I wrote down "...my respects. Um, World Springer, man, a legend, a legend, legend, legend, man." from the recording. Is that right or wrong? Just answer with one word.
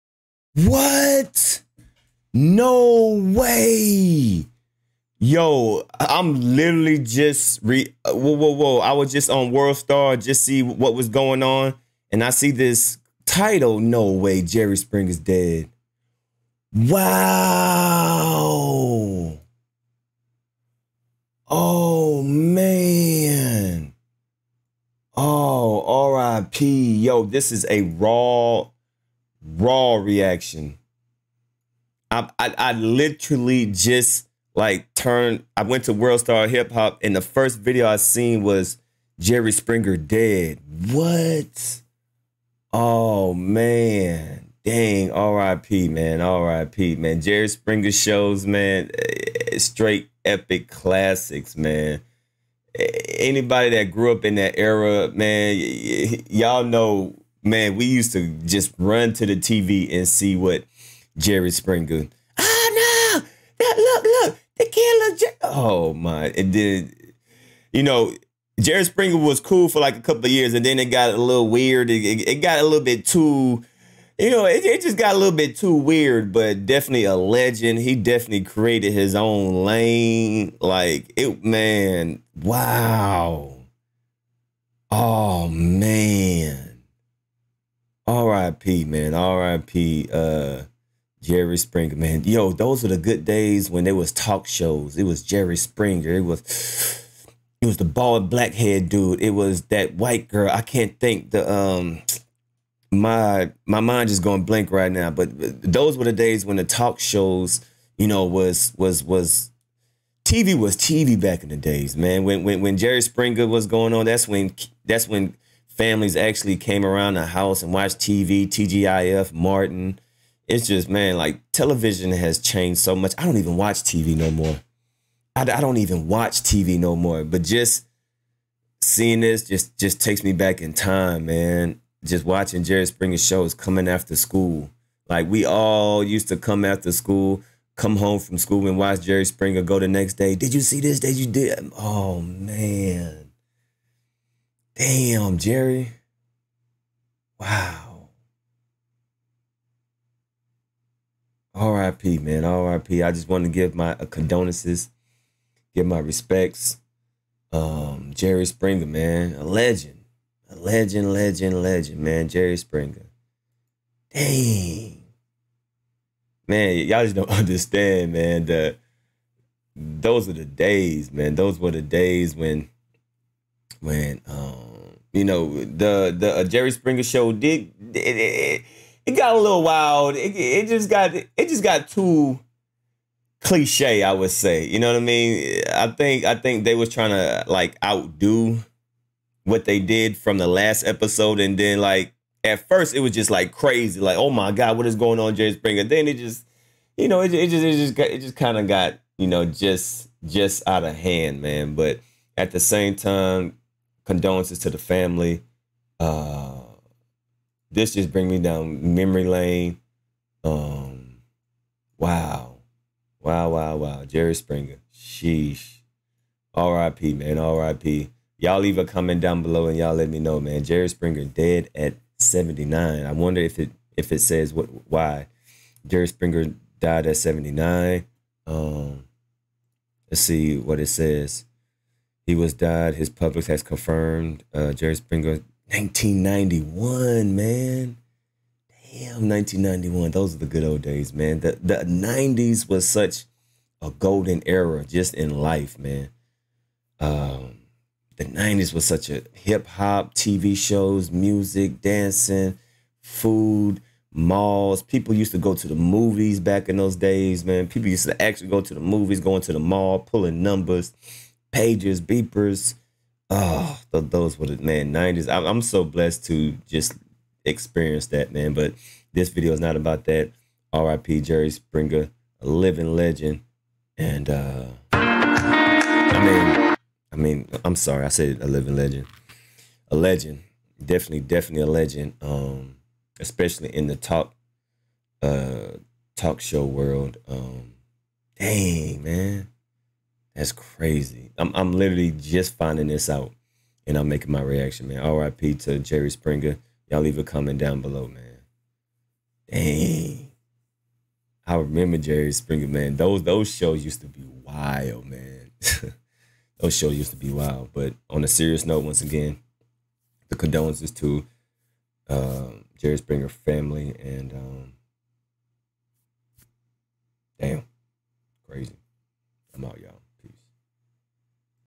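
wrong.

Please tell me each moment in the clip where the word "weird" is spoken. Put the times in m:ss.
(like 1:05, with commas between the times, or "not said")
1:11, 1:15.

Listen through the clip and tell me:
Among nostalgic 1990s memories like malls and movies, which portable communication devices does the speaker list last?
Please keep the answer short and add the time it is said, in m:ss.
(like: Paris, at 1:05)
beepers, at 4:22.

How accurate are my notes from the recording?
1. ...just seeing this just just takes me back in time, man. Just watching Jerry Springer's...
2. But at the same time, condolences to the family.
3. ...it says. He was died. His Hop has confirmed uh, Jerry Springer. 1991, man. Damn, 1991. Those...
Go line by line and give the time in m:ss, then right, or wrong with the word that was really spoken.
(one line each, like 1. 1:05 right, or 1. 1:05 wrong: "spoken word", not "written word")
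1. 2:07 right
2. 3:21 right
3. 3:50 wrong: "Publix", not "Hop".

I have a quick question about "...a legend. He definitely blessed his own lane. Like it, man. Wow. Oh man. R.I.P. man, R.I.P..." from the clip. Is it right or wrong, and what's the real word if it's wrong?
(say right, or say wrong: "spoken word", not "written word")
wrong: "created", not "blessed".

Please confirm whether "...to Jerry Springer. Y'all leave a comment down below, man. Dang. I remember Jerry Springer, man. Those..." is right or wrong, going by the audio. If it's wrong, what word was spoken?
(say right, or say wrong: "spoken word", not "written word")
right.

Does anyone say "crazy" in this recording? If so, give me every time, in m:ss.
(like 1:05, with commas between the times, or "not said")
3:13, 4:50, 5:18.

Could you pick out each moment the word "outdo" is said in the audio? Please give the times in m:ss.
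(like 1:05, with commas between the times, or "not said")
3:07.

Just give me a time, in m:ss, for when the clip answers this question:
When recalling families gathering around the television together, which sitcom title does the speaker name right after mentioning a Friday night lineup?
1:59.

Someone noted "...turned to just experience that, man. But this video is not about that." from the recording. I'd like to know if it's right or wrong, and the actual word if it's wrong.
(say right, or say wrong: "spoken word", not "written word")
wrong: "blessed", not "turned".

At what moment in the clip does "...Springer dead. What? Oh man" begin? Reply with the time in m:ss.
0:39.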